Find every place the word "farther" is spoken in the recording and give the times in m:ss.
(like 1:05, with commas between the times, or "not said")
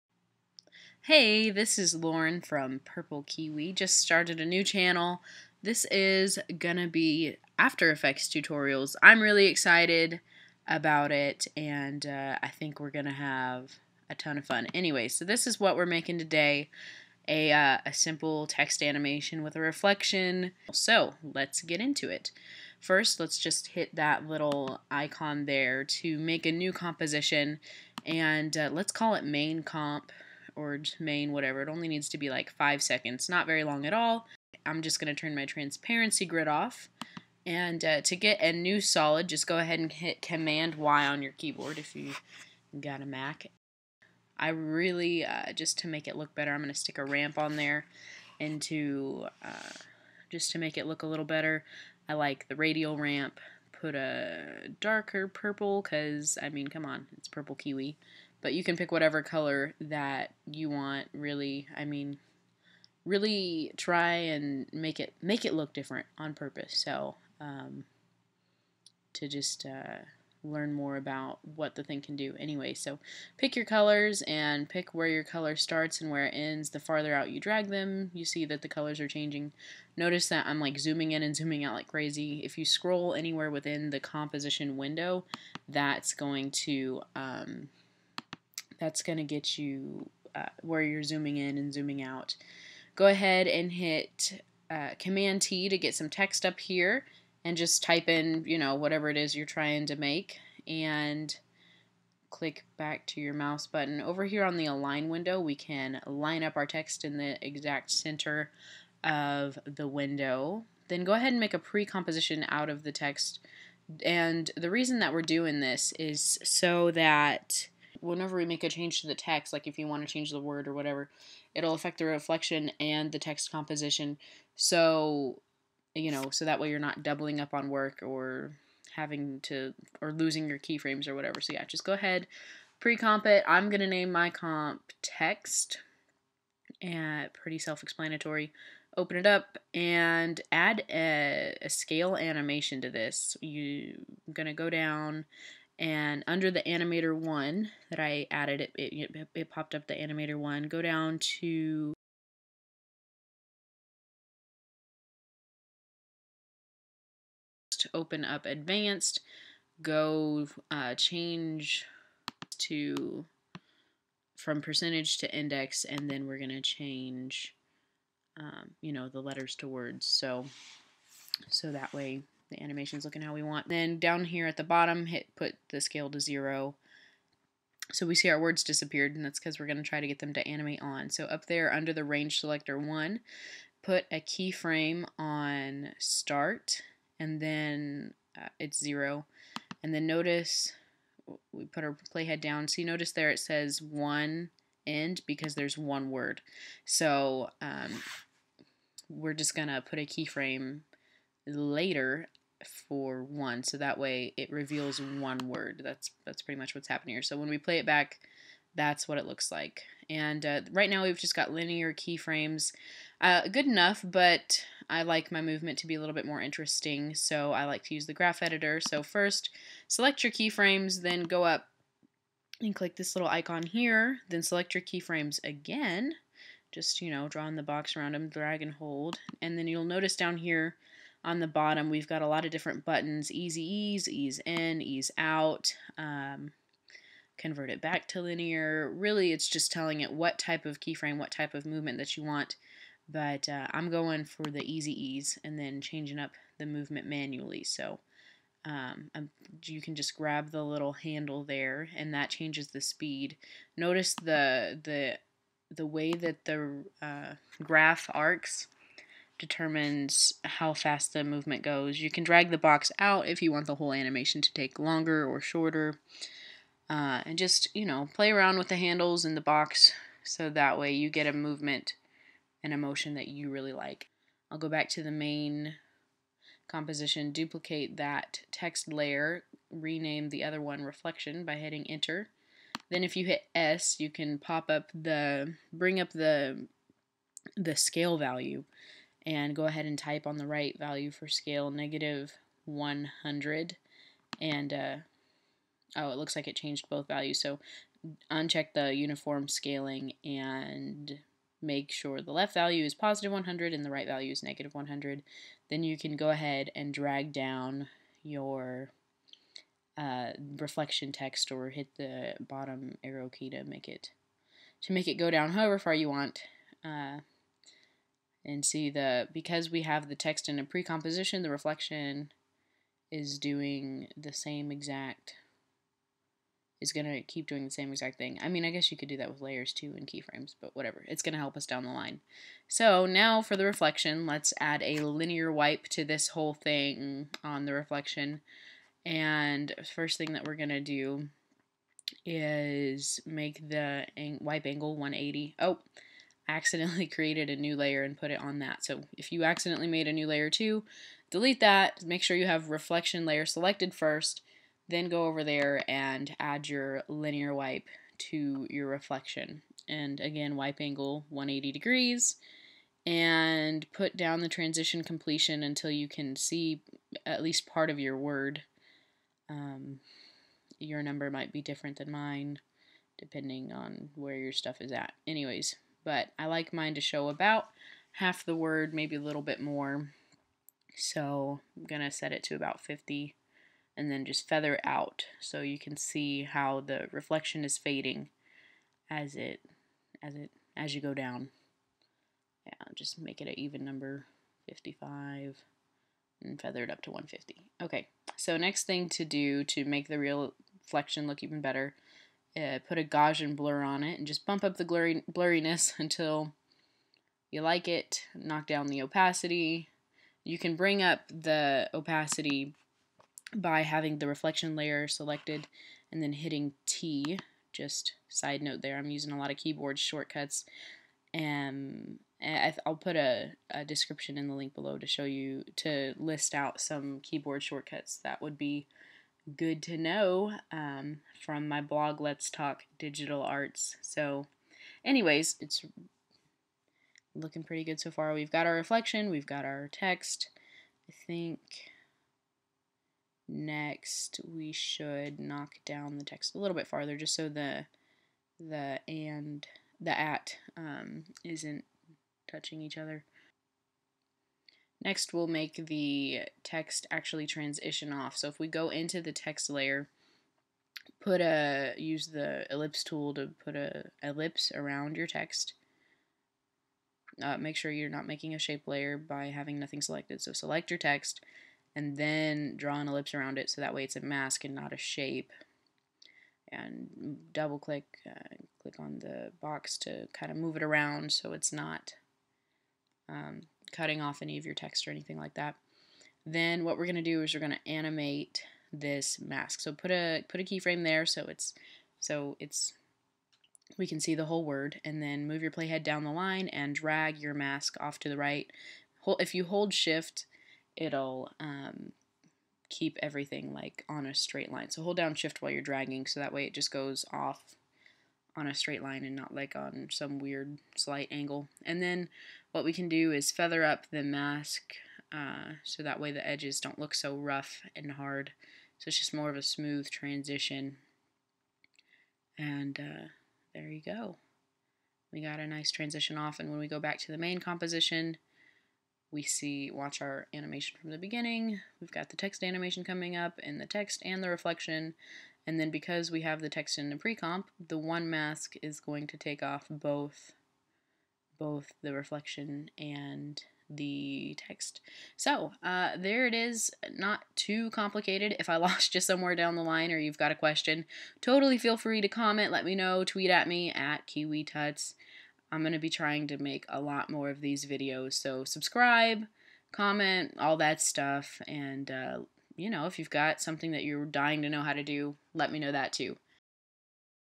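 1:16, 7:26.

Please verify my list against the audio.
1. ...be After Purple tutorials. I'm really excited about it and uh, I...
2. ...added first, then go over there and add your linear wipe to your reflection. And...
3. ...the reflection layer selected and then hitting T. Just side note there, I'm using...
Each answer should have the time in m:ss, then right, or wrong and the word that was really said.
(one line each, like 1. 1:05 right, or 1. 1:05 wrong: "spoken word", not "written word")
1. 0:06 wrong: "Effects", not "Purple"
2. 5:53 wrong: "selected", not "added"
3. 6:54 right.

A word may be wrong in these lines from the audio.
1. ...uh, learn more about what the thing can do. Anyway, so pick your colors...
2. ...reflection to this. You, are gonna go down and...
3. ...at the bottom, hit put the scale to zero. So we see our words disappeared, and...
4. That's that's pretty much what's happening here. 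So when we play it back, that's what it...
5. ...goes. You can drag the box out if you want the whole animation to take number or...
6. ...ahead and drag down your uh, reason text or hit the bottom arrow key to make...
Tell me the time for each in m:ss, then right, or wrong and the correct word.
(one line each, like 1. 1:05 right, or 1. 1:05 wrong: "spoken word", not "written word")
1. 1:09 right
2. 2:22 wrong: "animation", not "reflection"
3. 2:54 right
4. 3:25 right
5. 4:21 wrong: "longer", not "number"
6. 5:06 wrong: "reflection", not "reason".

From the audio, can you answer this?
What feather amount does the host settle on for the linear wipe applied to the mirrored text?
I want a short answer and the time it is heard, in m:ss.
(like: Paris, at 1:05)
150, at 6:37.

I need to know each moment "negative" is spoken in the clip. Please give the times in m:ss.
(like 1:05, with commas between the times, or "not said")
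4:51, 5:04.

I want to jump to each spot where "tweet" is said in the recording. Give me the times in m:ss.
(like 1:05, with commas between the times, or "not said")
9:13.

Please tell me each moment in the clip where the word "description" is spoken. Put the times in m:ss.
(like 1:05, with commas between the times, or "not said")
7:03.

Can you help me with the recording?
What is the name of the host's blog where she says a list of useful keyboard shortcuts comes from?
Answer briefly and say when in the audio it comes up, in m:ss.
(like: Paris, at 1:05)
Let's Talk Digital Arts, at 7:12.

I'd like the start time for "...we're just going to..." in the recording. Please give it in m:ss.
3:19.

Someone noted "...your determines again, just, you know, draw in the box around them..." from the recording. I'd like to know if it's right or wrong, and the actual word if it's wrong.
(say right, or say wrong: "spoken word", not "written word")
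wrong: "keyframes", not "determines".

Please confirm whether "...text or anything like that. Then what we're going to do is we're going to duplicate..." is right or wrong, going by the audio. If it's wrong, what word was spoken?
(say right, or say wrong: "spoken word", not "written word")
wrong: "animate", not "duplicate".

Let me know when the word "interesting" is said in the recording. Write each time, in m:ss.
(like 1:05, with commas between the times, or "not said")
3:36.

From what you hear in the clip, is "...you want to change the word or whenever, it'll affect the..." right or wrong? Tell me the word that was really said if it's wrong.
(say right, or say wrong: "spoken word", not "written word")
wrong: "whatever", not "whenever".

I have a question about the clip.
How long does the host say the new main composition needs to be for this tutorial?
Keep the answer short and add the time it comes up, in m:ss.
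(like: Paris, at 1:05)
5 seconds, at 0:32.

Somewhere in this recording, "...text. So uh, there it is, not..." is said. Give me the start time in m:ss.
9:04.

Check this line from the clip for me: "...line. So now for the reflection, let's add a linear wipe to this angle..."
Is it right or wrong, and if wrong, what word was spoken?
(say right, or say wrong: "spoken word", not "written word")
wrong: "whole", not "angle".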